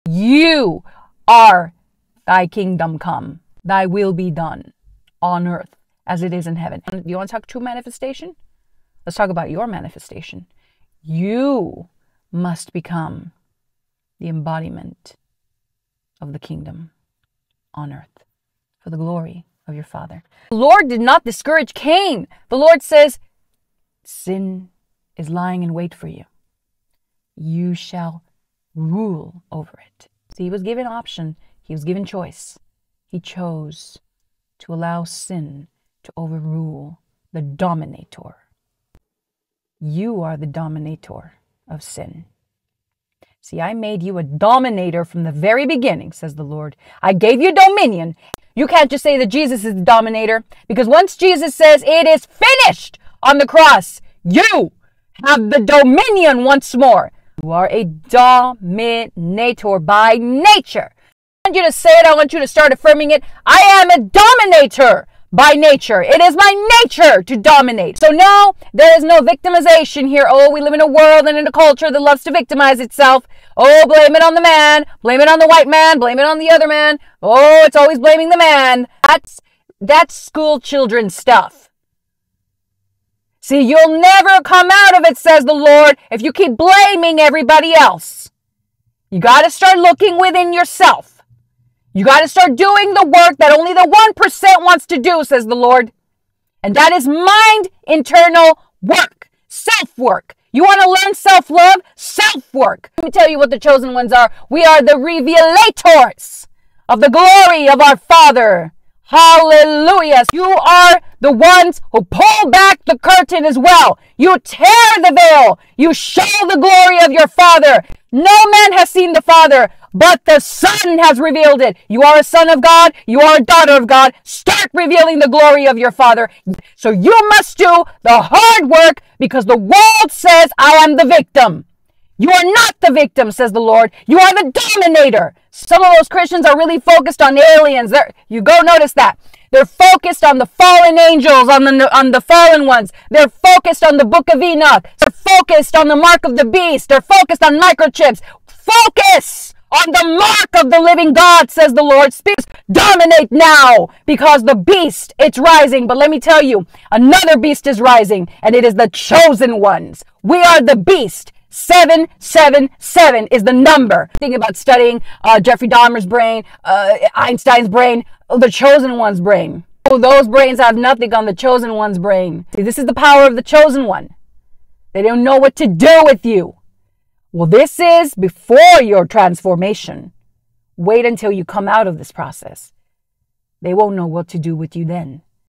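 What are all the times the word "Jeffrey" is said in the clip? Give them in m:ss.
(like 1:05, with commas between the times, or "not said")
2:45.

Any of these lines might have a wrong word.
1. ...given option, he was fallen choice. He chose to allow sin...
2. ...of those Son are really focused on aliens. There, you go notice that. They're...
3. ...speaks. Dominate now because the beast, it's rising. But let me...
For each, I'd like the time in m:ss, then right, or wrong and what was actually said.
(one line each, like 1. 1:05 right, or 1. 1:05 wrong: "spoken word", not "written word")
1. 0:30 wrong: "given", not "fallen"
2. 2:15 wrong: "Christians", not "Son"
3. 2:32 right.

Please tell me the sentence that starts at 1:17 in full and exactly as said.
Oh, it's always blaming the man.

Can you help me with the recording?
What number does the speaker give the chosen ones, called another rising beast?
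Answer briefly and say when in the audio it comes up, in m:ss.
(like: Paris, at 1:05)
777, at 2:41.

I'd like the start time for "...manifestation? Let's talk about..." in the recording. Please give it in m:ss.
0:07.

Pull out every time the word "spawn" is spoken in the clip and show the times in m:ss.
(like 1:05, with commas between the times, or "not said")
not said.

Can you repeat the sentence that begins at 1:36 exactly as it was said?
And that is mind internal work, self work.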